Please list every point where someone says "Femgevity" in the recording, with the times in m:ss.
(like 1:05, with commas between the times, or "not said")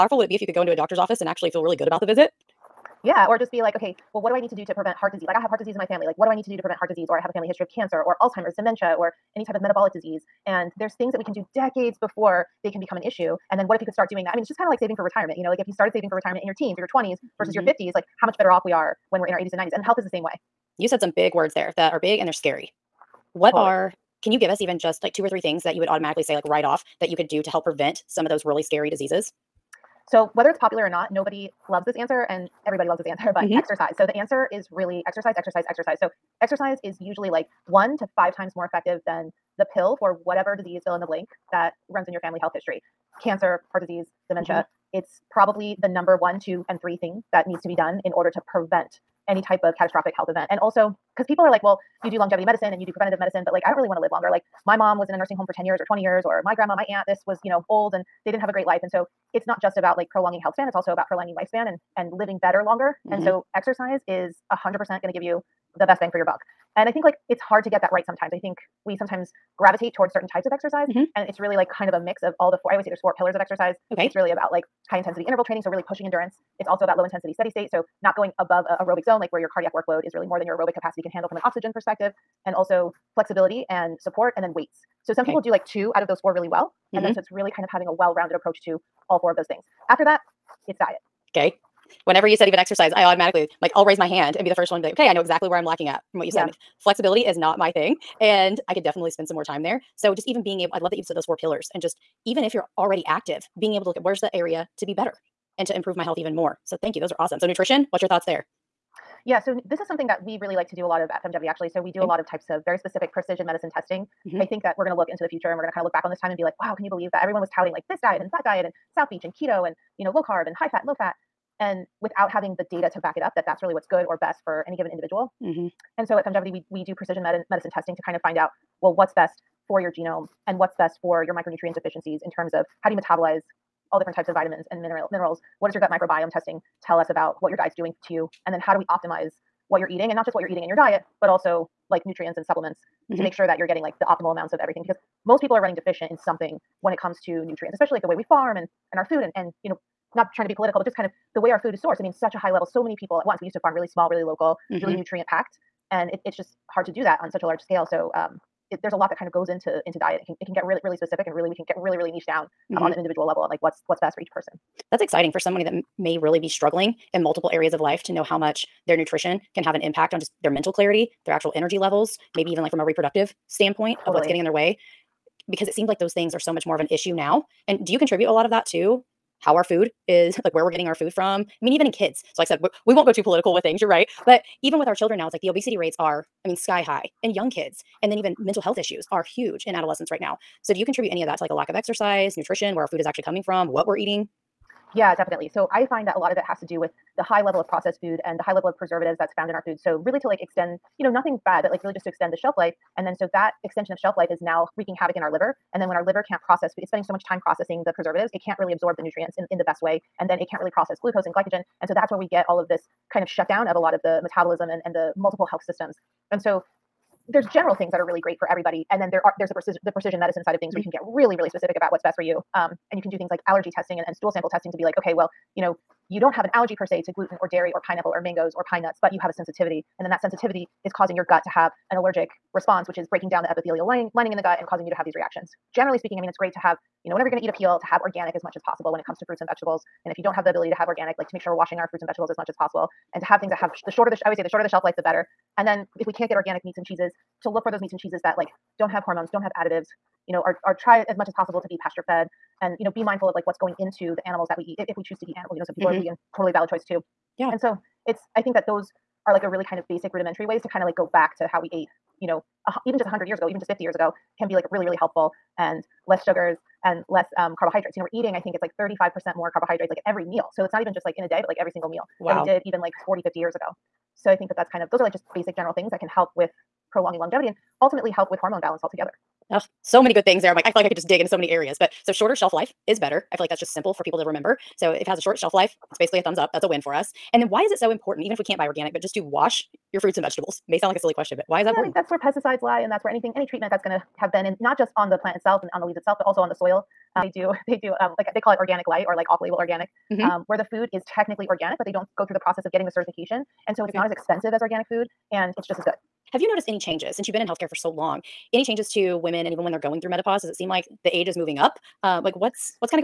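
1:51, 2:06.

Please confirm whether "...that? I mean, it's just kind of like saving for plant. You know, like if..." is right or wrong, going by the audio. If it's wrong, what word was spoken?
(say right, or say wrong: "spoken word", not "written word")
wrong: "retirement", not "plant".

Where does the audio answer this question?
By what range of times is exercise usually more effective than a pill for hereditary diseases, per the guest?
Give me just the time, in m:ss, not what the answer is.
0:37.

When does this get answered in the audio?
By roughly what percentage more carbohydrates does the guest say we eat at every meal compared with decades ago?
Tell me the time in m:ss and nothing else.
4:28.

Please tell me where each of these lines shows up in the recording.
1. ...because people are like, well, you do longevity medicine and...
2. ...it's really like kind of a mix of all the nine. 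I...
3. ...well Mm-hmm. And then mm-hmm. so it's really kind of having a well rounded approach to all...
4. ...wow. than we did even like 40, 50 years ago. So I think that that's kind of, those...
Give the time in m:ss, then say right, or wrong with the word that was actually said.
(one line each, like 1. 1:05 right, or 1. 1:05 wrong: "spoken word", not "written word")
1. 0:51 right
2. 1:11 wrong: "four", not "nine"
3. 1:26 right
4. 4:32 right.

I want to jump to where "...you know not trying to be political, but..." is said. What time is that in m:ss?
2:29.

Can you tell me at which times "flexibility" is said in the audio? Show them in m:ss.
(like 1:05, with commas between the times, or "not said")
1:23, 1:36.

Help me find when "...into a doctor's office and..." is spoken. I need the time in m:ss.
0:00.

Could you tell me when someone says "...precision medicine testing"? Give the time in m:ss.
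1:53.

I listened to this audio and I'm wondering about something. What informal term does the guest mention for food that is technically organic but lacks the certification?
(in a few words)
organic light.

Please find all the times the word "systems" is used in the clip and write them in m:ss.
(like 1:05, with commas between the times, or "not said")
3:35.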